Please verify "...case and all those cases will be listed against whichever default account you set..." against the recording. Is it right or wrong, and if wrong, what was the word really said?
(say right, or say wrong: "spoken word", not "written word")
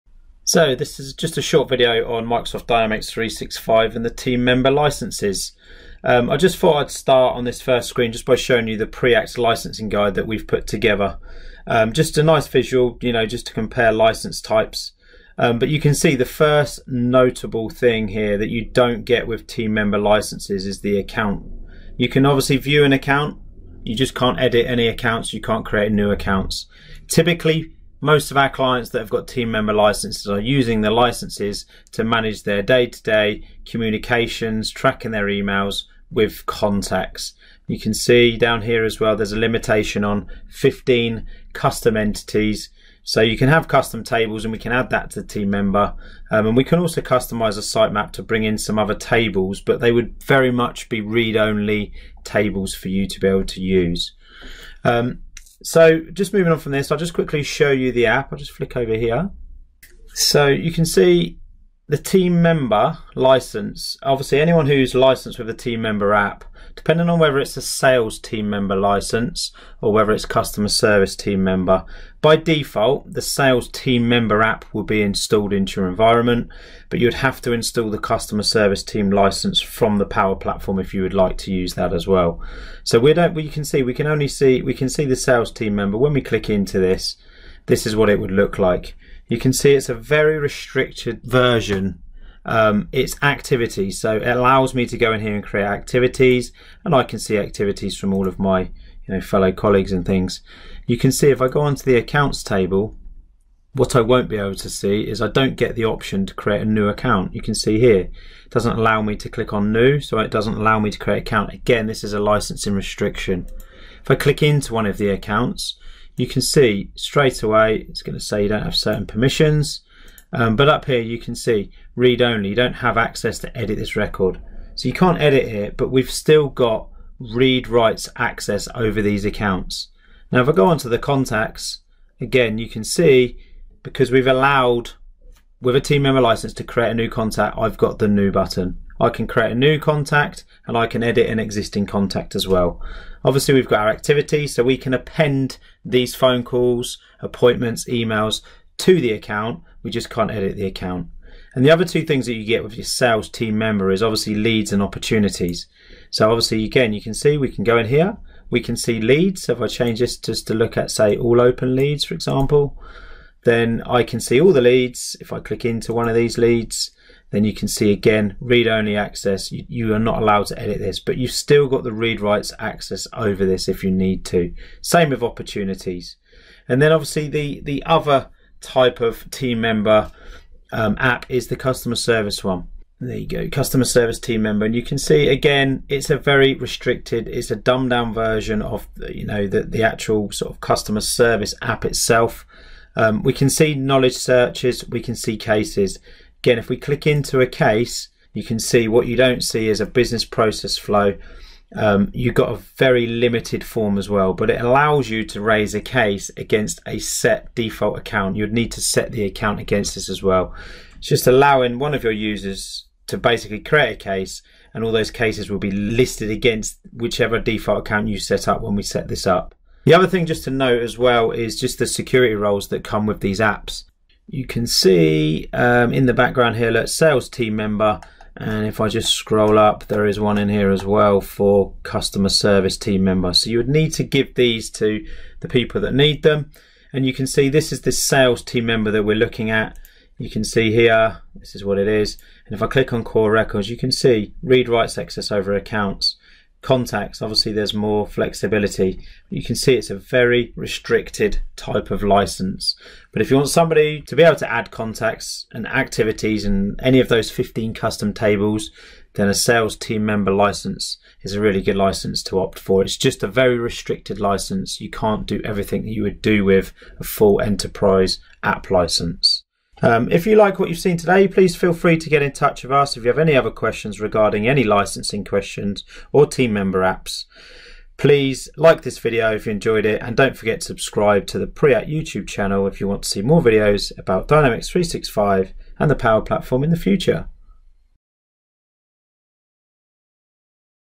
right.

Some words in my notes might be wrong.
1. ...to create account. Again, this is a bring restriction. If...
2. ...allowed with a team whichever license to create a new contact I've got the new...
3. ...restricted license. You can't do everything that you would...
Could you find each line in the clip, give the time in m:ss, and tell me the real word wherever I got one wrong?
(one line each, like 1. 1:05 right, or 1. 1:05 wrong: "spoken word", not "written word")
1. 1:50 wrong: "licensing", not "bring"
2. 2:14 wrong: "member", not "whichever"
3. 4:23 right.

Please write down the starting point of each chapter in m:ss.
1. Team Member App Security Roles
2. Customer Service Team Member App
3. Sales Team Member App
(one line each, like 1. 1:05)
1. 3:40
2. 2:56
3. 1:00.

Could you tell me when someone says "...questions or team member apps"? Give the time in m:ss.
4:35.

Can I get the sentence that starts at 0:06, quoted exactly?
Um, I just thought I'd start on this first screen just by showing you the Preact licensing guide that we've put together.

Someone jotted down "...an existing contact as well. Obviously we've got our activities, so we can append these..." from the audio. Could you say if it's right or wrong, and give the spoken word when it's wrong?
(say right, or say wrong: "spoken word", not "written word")
right.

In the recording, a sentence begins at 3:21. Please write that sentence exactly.
Um, you've got a very limited form as well, but it allows you to raise a case against a set default account.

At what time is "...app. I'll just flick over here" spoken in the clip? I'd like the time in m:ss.
0:58.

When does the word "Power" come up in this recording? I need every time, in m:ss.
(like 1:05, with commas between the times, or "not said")
1:20, 4:45.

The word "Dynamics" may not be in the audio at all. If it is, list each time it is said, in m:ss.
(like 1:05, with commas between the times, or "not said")
0:02, 4:44.